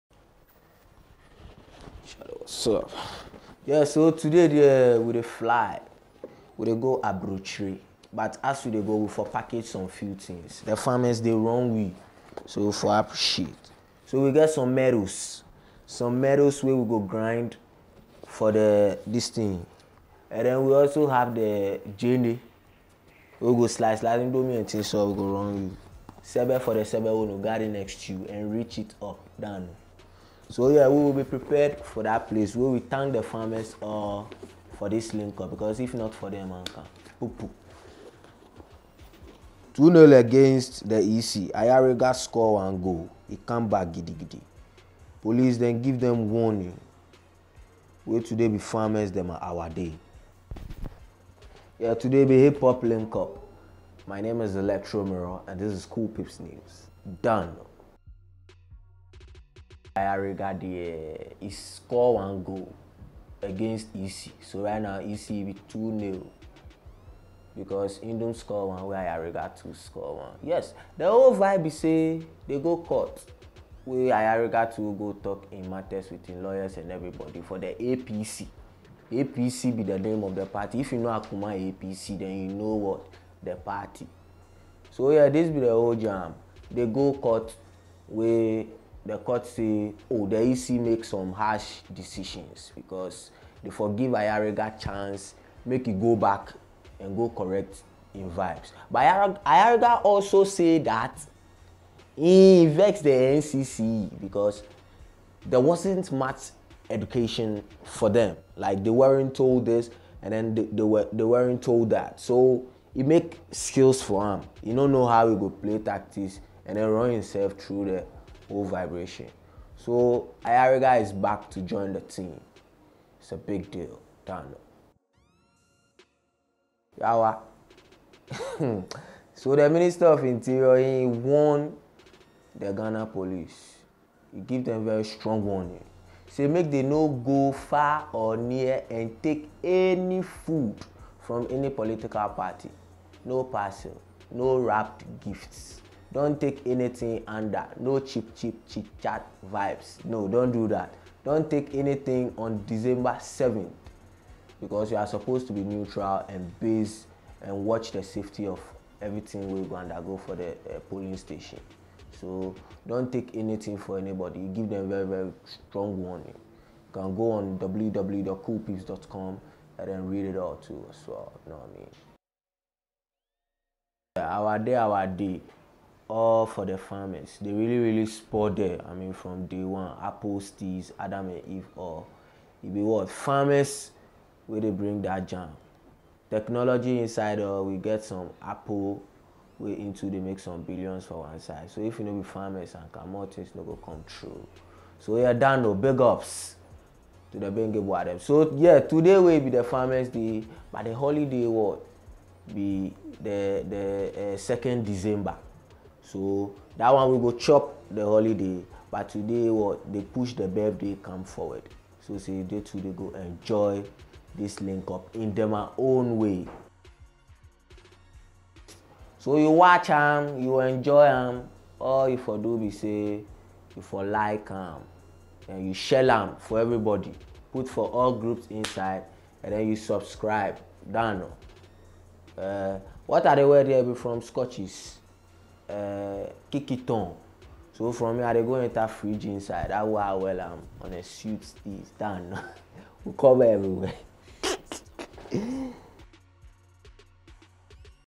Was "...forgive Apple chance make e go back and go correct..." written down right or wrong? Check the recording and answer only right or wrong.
wrong.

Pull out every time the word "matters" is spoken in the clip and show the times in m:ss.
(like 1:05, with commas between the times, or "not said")
1:15.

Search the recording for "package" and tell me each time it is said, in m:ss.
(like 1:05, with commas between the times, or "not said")
0:09.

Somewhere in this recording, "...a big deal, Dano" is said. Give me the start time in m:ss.
2:03.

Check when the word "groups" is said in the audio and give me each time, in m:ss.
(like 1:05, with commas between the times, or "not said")
3:48.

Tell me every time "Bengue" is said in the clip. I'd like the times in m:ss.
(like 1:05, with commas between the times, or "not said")
3:17.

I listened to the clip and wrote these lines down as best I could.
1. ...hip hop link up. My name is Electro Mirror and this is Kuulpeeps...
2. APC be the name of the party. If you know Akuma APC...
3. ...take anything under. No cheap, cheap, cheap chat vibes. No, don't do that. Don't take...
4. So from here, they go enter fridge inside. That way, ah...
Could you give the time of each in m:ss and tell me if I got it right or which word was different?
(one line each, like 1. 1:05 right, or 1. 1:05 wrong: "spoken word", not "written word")
1. 0:52 right
2. 1:19 right
3. 2:26 right
4. 3:57 right.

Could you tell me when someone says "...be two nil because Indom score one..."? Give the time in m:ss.
1:05.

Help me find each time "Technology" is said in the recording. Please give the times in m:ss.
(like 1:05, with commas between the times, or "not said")
3:06.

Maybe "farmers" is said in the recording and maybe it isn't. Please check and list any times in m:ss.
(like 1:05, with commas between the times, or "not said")
0:10, 0:33, 0:48, 2:56, 3:03, 3:12, 3:19.